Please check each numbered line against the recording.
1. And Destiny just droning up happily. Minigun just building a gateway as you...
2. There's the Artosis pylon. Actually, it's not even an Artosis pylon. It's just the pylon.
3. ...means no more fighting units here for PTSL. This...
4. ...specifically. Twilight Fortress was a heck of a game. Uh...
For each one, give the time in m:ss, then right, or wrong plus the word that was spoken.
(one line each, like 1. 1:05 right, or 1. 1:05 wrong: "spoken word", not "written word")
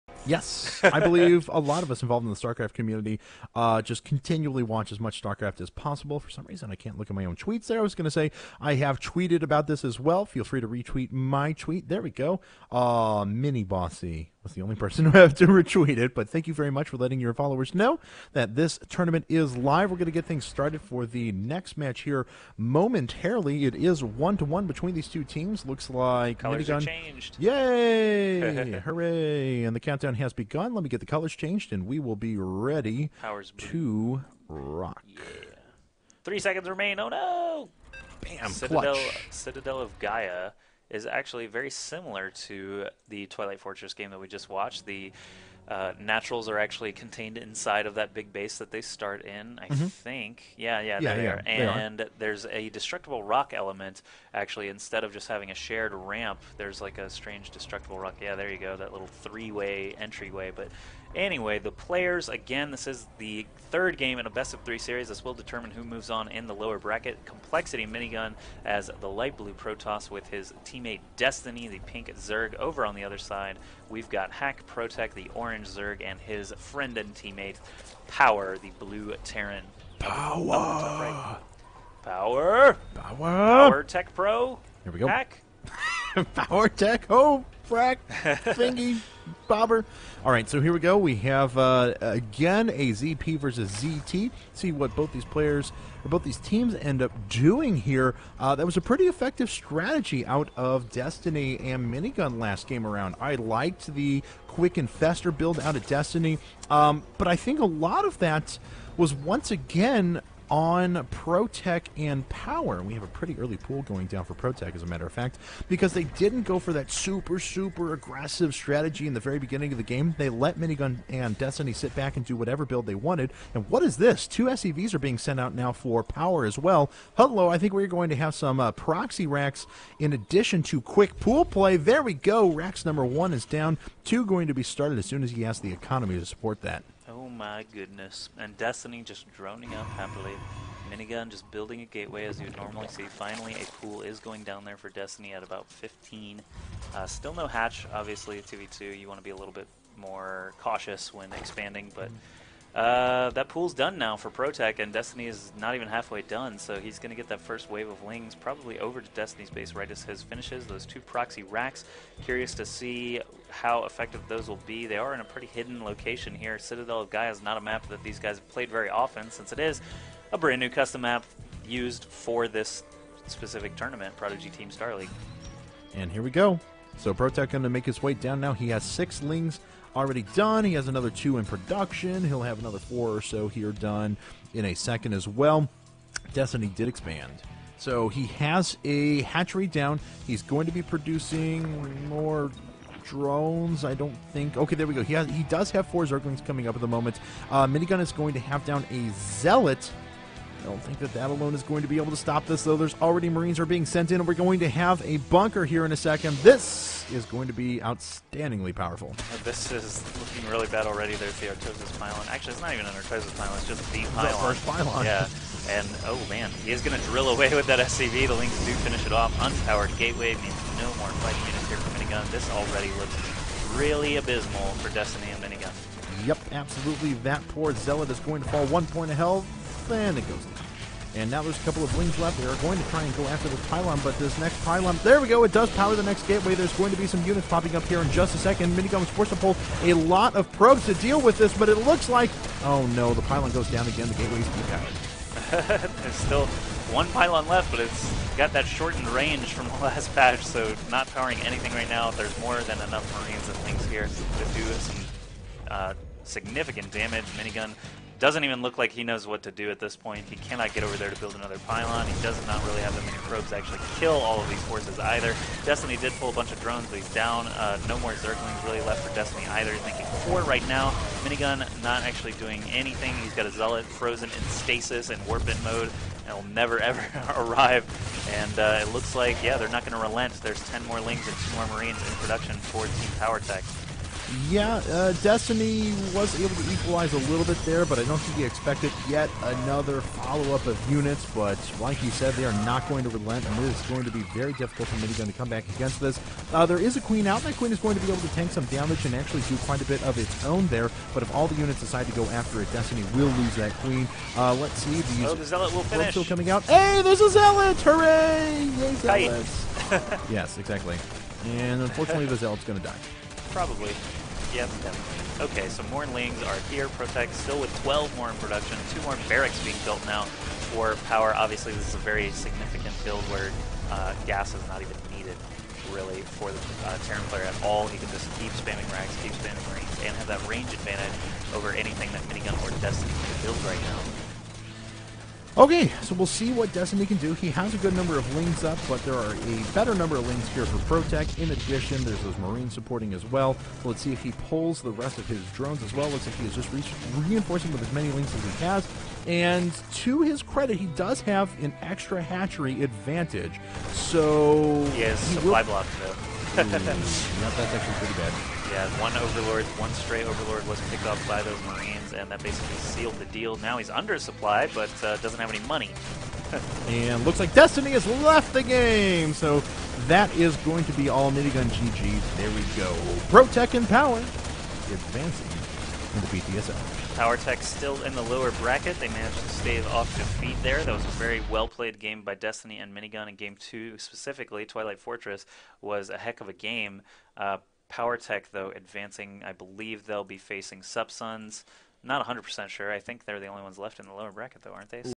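1. 2:18 right
2. 3:31 right
3. 3:40 wrong: "Minigun", not "PTSL"
4. 6:23 right.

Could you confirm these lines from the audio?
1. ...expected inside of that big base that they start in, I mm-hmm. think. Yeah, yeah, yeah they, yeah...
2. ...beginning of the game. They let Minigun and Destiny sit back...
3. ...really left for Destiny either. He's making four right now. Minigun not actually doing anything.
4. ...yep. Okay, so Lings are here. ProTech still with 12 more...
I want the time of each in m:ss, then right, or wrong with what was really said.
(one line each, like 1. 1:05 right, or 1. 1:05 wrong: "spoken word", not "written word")
1. 0:46 wrong: "contained", not "expected"
2. 1:59 right
3. 4:28 right
4. 5:14 right.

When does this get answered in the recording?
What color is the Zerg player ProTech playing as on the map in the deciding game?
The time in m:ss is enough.
1:15.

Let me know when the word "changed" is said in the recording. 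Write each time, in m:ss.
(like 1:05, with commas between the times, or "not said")
0:26, 0:31.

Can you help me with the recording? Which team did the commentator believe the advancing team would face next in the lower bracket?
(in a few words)
Subsuns.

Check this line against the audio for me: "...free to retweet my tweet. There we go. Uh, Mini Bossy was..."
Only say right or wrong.
right.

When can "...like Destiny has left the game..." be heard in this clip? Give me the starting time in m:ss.
6:07.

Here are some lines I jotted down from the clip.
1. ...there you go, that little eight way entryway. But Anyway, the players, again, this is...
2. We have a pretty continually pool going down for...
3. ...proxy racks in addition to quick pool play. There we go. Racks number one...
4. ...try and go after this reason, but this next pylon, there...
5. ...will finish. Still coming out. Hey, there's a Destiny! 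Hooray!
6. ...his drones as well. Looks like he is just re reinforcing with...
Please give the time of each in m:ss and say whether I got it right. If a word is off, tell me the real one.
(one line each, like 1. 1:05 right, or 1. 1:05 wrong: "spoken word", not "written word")
1. 0:58 wrong: "three", not "eight"
2. 1:52 wrong: "early", not "continually"
3. 2:08 right
4. 3:52 wrong: "pylon", not "reason"
5. 5:05 wrong: "Zealot", not "Destiny"
6. 5:45 right.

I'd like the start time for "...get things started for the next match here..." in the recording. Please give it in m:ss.
0:20.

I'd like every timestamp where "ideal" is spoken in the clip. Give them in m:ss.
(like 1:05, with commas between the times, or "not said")
not said.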